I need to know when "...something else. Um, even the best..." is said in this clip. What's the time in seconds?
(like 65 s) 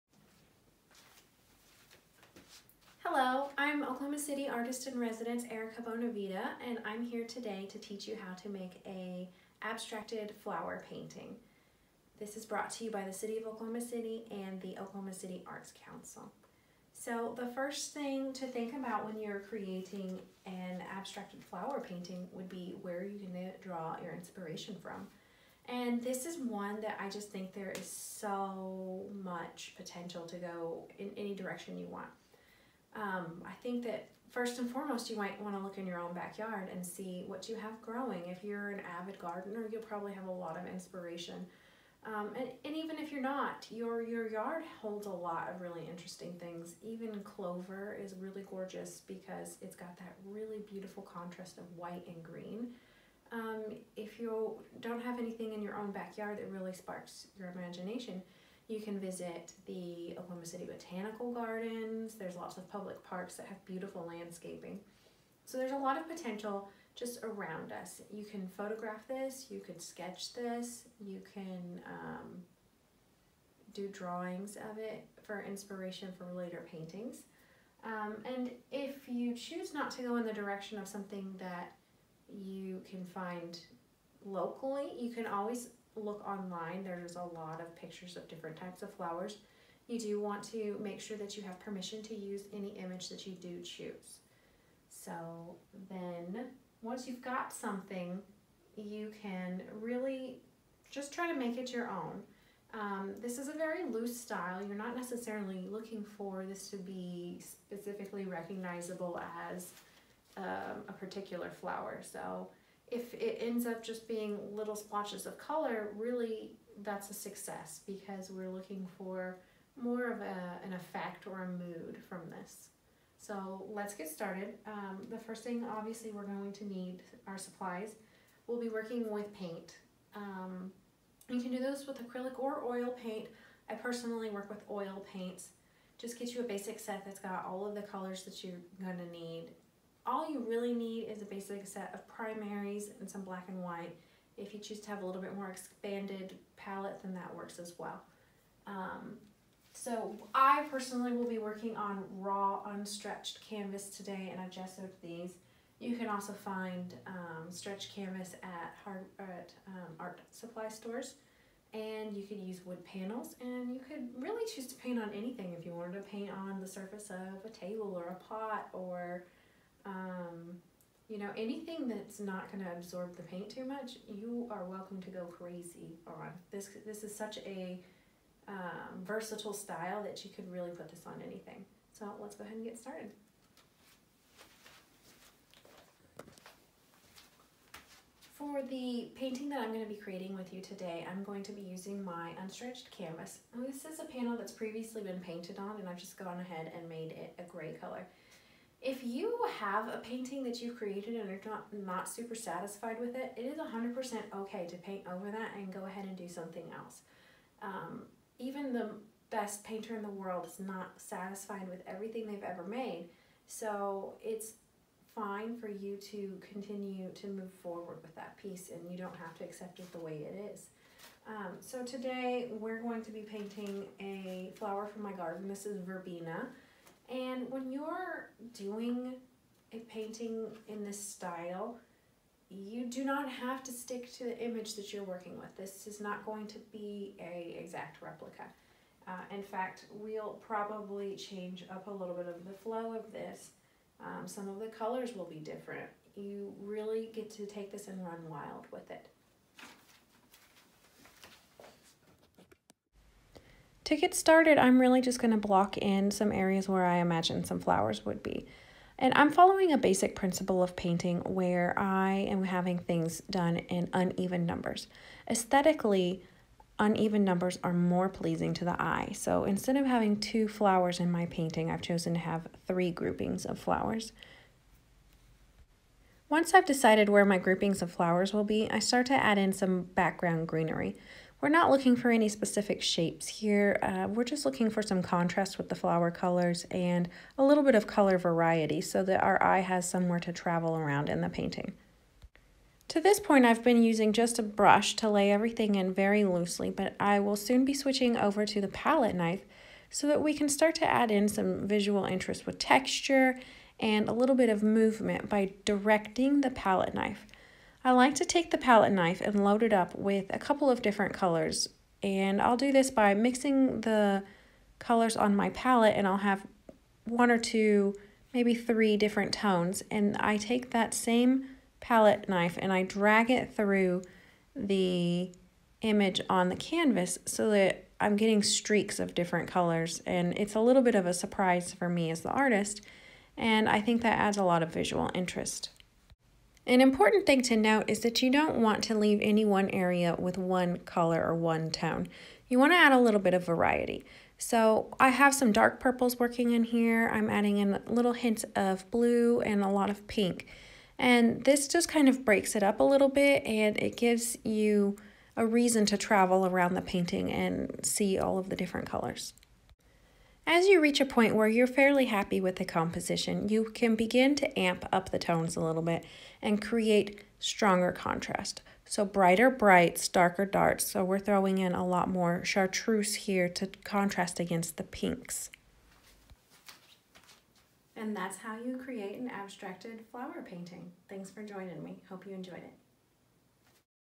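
206 s.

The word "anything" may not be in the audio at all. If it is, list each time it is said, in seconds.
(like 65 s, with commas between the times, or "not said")
55 s, 165 s, 171 s, 181 s.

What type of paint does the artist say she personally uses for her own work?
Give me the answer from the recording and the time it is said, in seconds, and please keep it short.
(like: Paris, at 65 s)
Oil paints, at 134 s.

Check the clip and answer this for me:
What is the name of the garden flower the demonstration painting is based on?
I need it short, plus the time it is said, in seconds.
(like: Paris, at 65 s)
Verbena, at 225 s.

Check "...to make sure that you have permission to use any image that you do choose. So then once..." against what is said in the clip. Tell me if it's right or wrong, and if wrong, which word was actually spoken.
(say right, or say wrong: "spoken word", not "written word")
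right.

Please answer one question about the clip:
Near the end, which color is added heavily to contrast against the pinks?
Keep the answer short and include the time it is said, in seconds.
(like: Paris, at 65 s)
Chartreuse, at 372 s.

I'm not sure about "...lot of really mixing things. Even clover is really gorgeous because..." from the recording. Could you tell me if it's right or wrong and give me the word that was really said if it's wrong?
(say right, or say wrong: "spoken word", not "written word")
wrong: "interesting", not "mixing".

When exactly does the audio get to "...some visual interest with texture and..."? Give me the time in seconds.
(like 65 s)
301 s.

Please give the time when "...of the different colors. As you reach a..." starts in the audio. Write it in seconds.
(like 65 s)
358 s.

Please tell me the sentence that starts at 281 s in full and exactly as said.
We're not looking for any specific shapes here.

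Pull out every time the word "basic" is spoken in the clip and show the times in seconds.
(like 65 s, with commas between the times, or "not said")
136 s, 141 s, 259 s.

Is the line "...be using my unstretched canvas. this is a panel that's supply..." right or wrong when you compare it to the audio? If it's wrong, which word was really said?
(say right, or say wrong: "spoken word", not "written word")
wrong: "previously", not "supply".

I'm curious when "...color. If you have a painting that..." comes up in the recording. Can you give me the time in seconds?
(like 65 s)
197 s.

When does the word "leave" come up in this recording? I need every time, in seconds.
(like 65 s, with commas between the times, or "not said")
338 s.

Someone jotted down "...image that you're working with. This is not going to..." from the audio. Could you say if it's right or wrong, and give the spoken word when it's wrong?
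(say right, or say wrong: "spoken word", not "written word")
right.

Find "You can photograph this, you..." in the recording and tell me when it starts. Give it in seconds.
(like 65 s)
68 s.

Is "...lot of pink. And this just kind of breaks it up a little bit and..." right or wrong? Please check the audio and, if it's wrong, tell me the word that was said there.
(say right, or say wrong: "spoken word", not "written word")
right.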